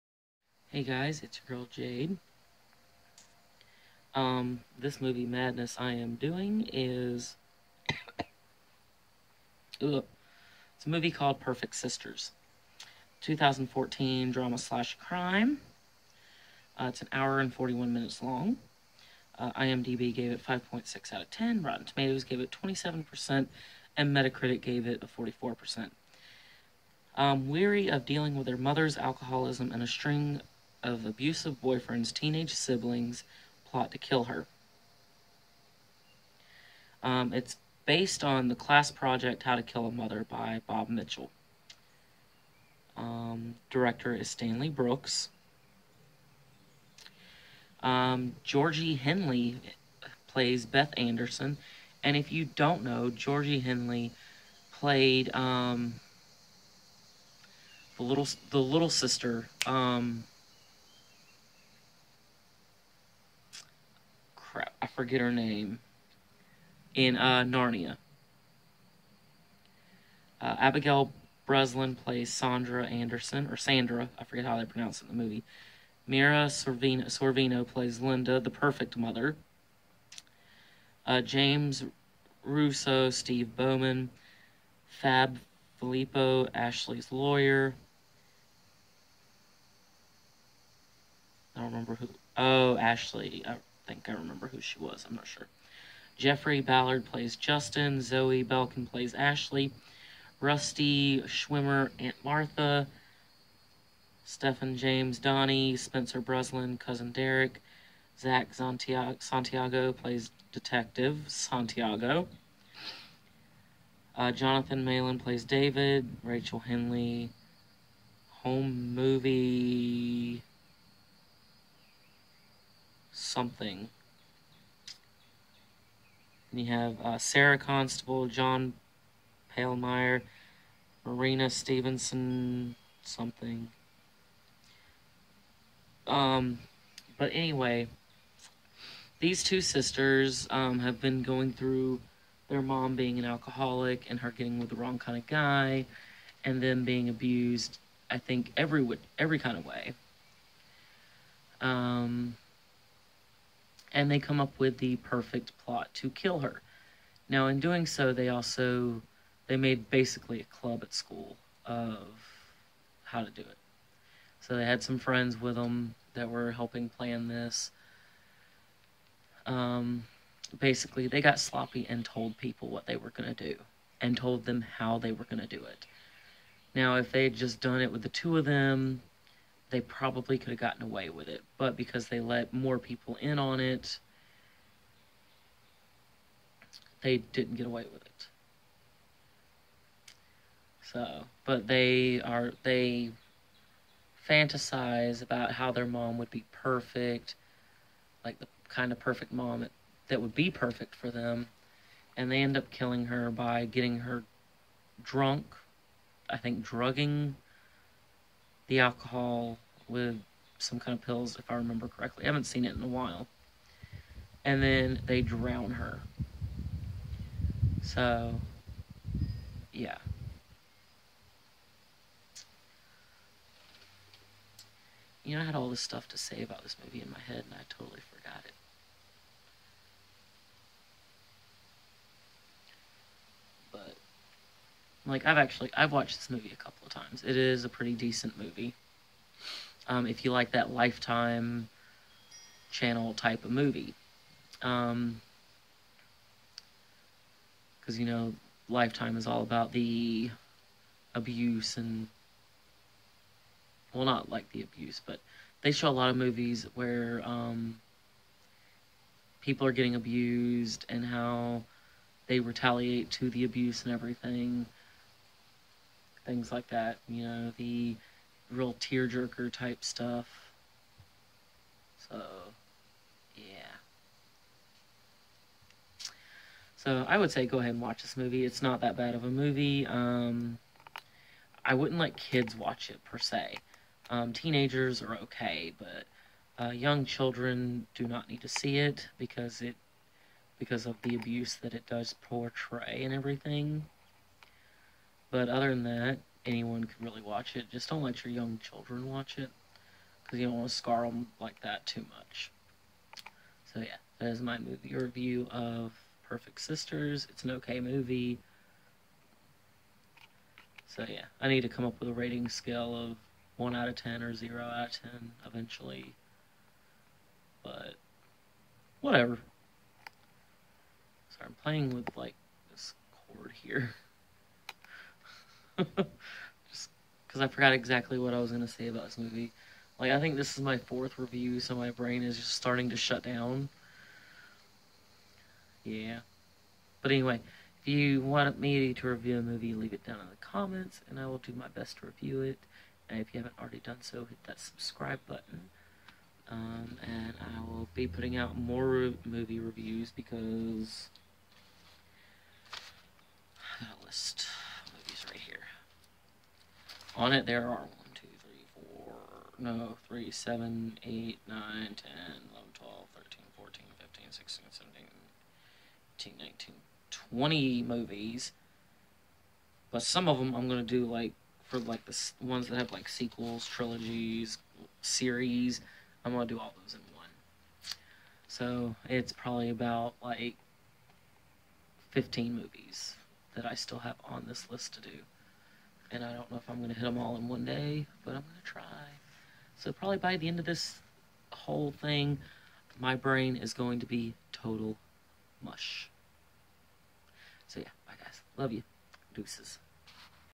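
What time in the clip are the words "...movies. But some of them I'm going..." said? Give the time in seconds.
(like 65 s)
367 s.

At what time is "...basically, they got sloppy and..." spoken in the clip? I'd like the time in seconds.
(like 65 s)
170 s.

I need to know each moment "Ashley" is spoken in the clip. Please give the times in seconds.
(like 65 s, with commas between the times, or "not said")
86 s, 92 s, 99 s.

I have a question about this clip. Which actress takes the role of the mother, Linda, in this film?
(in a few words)
Mira Sorvino.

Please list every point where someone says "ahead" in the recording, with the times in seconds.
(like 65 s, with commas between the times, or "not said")
277 s.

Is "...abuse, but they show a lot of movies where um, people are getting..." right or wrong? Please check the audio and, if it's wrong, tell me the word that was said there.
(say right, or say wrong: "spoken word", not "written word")
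right.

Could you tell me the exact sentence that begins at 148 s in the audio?
I think every every kind of way.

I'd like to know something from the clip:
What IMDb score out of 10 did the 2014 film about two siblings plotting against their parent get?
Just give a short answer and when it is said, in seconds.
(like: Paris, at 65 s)
5.6, at 20 s.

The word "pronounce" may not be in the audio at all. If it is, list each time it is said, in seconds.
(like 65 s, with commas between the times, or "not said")
74 s.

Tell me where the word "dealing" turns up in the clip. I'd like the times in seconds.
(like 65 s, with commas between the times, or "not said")
28 s.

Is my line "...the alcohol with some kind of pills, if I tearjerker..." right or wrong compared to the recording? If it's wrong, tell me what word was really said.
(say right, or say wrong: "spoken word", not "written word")
wrong: "remember", not "tearjerker".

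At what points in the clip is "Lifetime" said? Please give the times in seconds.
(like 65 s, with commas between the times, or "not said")
240 s, 248 s.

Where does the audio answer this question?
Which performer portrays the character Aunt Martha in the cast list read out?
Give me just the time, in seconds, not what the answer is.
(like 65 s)
100 s.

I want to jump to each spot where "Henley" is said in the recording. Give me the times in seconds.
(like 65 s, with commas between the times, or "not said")
48 s, 53 s, 116 s.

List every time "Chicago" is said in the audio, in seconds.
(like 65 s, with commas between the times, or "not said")
not said.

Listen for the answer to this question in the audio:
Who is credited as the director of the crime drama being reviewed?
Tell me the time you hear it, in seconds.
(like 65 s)
44 s.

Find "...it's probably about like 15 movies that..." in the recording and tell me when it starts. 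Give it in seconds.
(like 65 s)
379 s.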